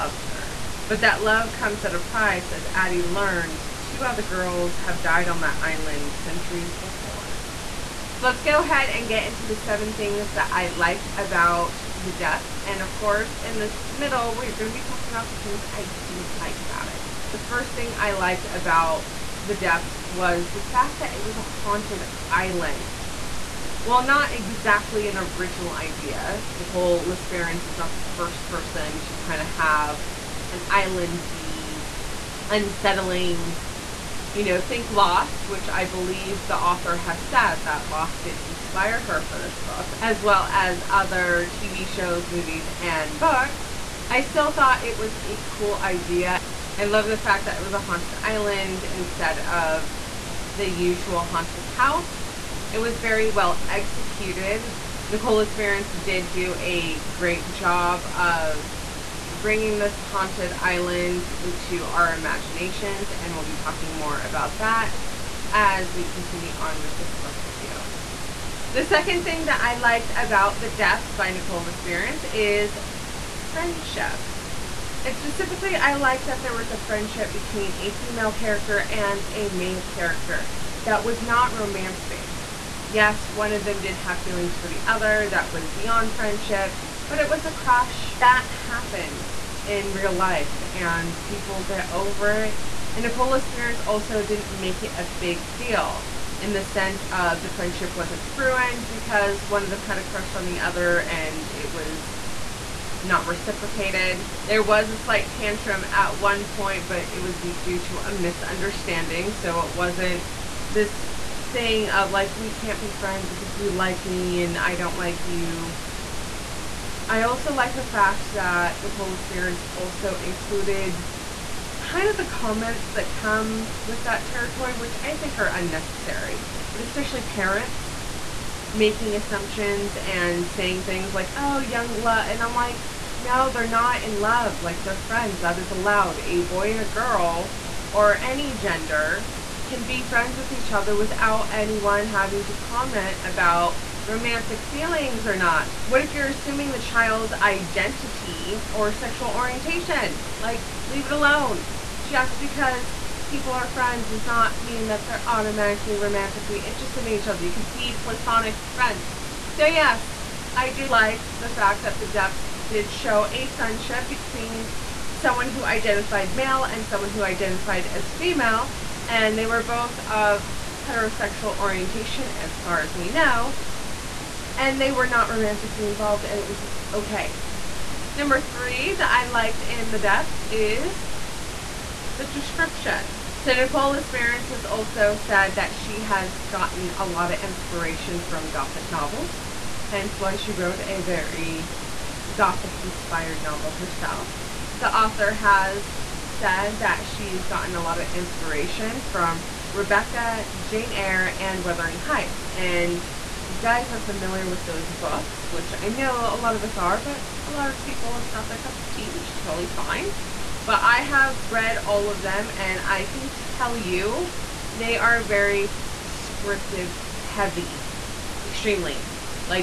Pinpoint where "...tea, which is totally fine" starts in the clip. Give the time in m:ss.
3:28.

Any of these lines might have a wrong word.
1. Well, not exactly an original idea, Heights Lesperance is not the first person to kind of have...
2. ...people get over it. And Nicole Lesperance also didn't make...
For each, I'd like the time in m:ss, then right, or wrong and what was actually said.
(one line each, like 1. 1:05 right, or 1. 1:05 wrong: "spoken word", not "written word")
1. 0:23 wrong: "Nicole", not "Heights"
2. 1:31 right.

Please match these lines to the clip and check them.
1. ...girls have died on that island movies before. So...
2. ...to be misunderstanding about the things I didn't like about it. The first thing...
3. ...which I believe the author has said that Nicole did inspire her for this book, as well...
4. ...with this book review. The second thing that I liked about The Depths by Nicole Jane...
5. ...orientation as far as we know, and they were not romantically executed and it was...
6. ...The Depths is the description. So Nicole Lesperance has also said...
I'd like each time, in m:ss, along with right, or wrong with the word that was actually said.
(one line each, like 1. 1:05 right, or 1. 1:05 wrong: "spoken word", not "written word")
1. 0:04 wrong: "centuries", not "movies"
2. 0:14 wrong: "talking", not "misunderstanding"
3. 0:35 wrong: "Lost", not "Nicole"
4. 1:06 wrong: "Lesperance", not "Jane"
5. 2:51 wrong: "involved", not "executed"
6. 2:59 right.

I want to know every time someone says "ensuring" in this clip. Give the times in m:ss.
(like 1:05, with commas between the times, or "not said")
not said.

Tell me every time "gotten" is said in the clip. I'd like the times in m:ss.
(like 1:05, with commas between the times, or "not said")
3:06, 3:17.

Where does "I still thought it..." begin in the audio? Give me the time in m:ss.
0:44.